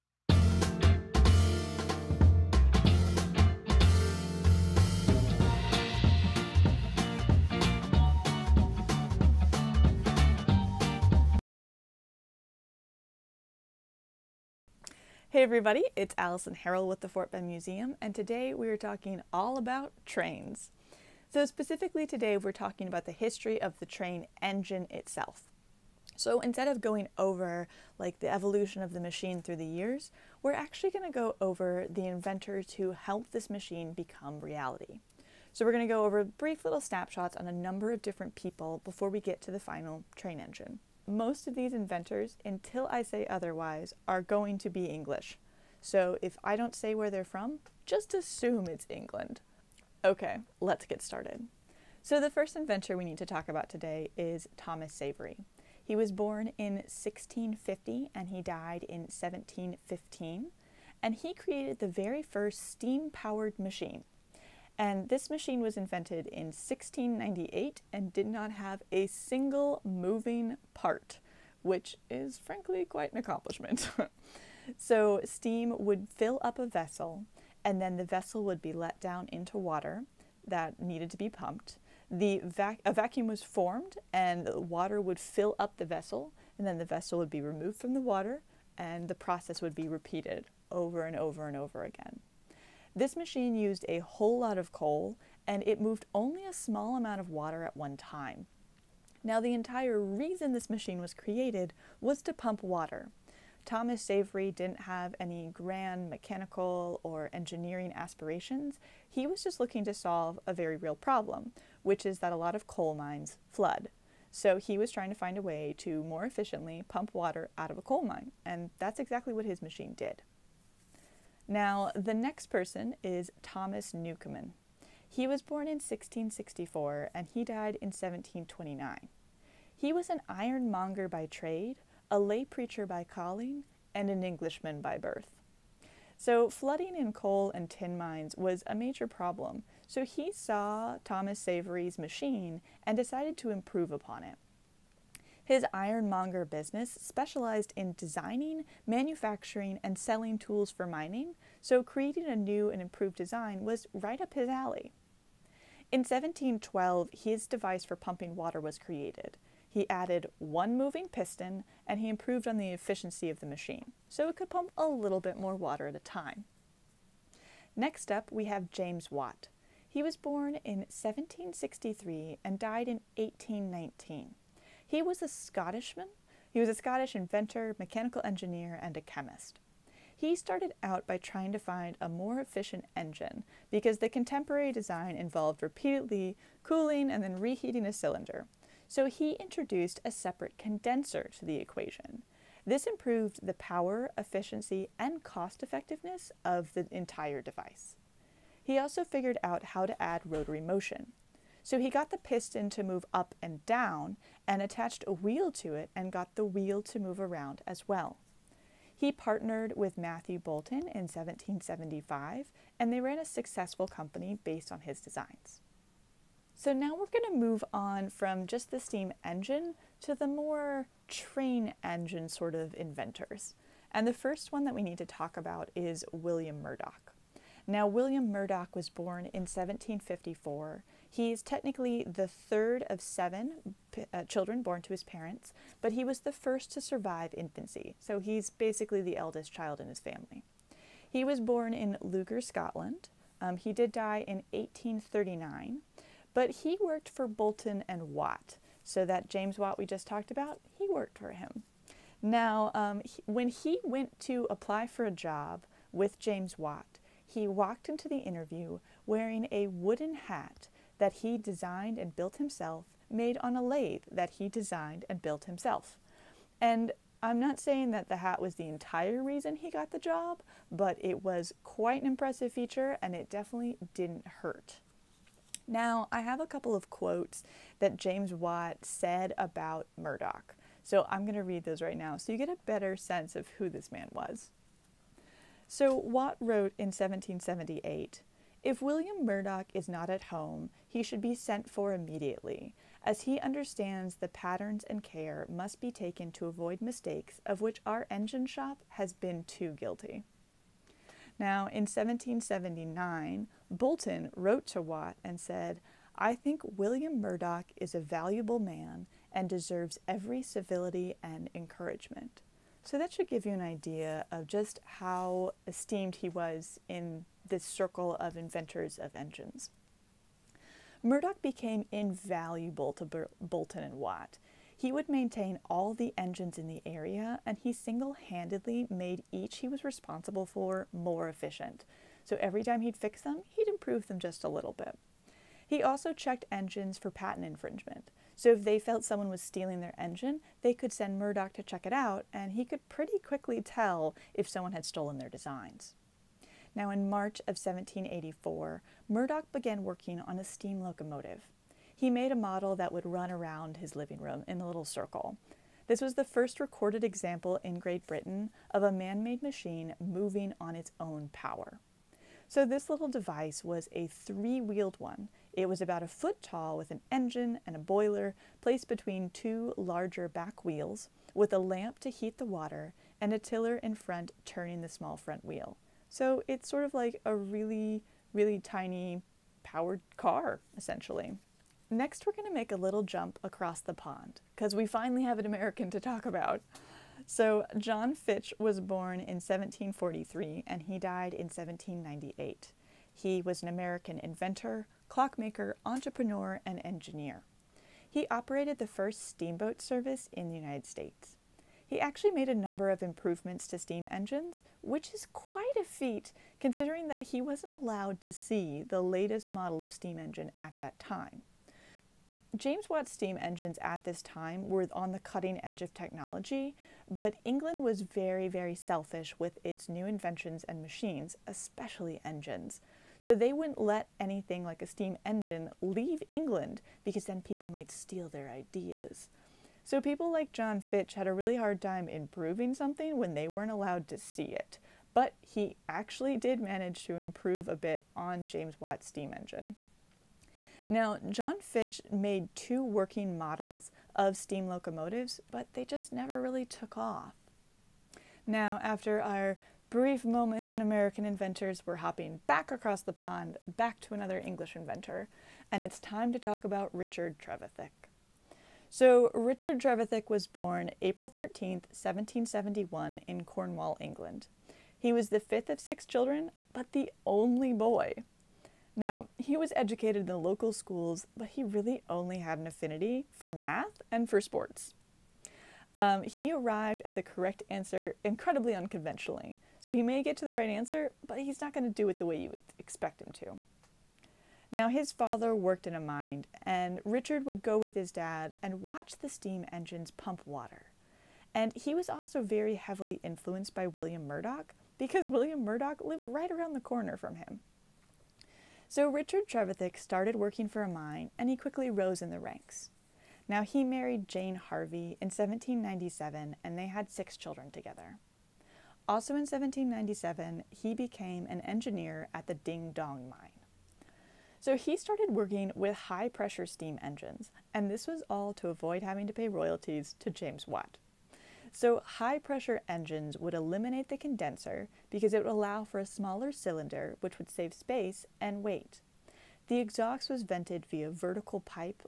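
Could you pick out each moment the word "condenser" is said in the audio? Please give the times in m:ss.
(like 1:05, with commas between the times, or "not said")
3:10, 8:44.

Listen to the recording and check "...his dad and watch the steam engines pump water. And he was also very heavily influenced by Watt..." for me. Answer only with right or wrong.
wrong.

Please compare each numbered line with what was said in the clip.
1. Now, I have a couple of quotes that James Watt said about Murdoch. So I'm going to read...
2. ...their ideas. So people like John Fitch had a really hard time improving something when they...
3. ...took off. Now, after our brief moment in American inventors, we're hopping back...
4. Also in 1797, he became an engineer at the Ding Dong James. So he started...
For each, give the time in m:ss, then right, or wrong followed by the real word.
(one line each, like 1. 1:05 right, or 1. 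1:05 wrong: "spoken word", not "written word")
1. 4:35 right
2. 7:08 right
3. 7:26 right
4. 8:29 wrong: "Mine", not "James".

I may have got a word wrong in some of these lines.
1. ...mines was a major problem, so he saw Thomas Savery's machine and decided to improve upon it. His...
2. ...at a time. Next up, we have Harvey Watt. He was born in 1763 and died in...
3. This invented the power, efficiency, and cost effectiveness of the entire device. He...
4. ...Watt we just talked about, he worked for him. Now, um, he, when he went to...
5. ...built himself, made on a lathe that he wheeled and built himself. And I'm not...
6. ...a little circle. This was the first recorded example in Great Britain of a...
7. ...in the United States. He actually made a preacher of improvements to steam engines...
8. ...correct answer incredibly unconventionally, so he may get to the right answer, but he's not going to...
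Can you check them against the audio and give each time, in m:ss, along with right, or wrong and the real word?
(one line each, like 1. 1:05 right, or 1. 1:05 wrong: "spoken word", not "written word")
1. 2:17 right
2. 2:45 wrong: "James", not "Harvey"
3. 3:12 wrong: "improved", not "invented"
4. 4:09 right
5. 4:22 wrong: "designed", not "wheeled"
6. 5:54 right
7. 6:40 wrong: "number", not "preacher"
8. 7:57 right.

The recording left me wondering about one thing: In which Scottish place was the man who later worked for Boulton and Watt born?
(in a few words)
Lugar, Scotland.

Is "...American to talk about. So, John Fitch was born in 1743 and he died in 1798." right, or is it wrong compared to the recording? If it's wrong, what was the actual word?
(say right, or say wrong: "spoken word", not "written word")
right.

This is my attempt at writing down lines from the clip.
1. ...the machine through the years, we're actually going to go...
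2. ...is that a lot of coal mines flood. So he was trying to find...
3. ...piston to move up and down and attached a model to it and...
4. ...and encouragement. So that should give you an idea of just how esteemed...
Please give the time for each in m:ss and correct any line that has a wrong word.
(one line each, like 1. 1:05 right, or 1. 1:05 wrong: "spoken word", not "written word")
1. 0:28 right
2. 1:52 right
3. 3:22 wrong: "wheel", not "model"
4. 5:11 right.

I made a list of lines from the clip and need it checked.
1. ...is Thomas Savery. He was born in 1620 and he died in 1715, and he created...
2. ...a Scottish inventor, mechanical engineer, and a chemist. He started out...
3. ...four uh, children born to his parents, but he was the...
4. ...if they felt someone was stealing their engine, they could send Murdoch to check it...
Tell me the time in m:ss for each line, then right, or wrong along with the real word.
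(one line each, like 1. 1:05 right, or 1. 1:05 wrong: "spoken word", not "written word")
1. 0:54 wrong: "1650", not "1620"
2. 2:56 right
3. 3:52 wrong: "seven", not "four"
4. 5:38 right.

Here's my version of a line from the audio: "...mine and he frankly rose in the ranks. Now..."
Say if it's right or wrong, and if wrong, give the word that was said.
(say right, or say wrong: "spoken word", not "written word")
wrong: "quickly", not "frankly".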